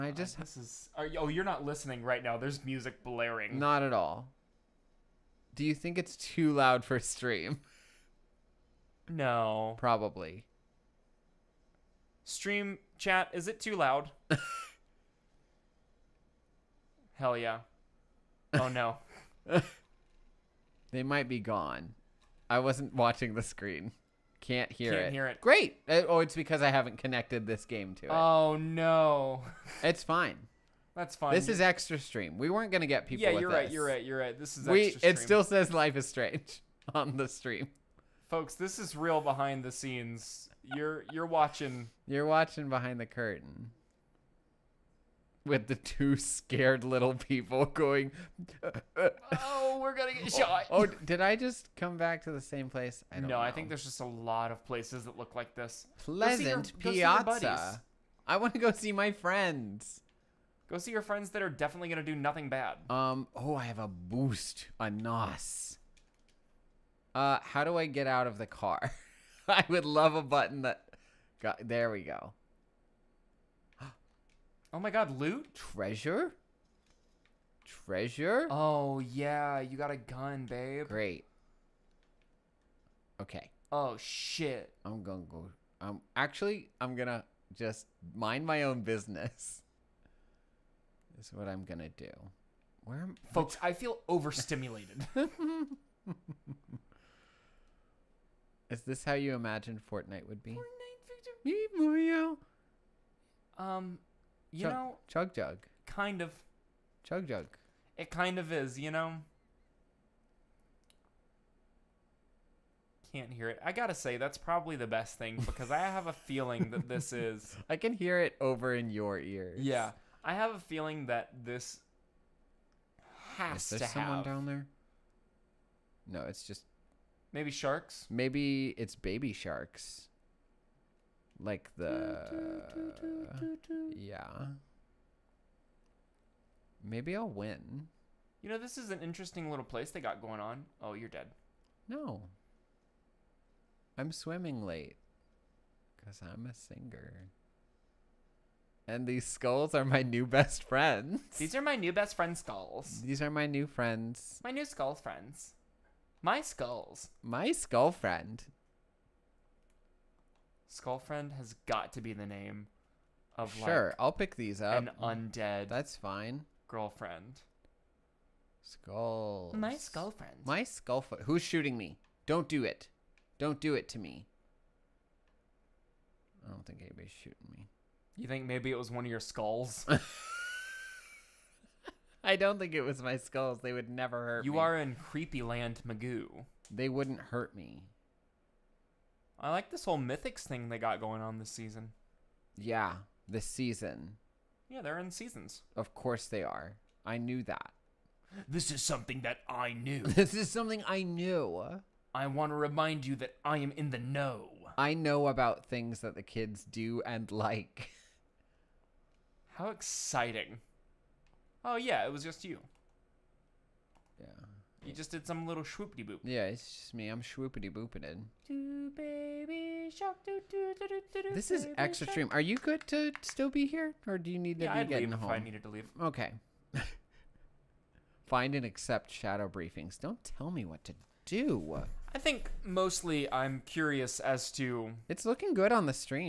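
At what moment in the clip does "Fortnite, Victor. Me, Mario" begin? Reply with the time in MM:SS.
01:40.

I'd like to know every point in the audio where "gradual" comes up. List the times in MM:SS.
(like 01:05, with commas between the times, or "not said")
not said.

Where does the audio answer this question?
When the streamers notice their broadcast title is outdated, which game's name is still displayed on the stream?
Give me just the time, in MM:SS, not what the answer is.
00:35.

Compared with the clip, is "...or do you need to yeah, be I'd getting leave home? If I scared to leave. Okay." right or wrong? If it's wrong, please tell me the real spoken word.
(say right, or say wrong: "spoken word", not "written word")
wrong: "needed", not "scared".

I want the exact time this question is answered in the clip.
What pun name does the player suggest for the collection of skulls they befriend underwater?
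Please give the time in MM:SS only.
02:40.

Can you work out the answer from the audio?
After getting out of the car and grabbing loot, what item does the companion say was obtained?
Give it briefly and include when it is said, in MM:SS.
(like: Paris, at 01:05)
a gun, at 01:19.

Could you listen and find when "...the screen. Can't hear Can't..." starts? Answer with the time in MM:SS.
00:23.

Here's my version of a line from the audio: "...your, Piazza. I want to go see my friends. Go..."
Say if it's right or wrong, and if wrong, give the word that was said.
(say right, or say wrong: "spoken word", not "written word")
right.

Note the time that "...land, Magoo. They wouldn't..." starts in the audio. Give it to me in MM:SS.
03:05.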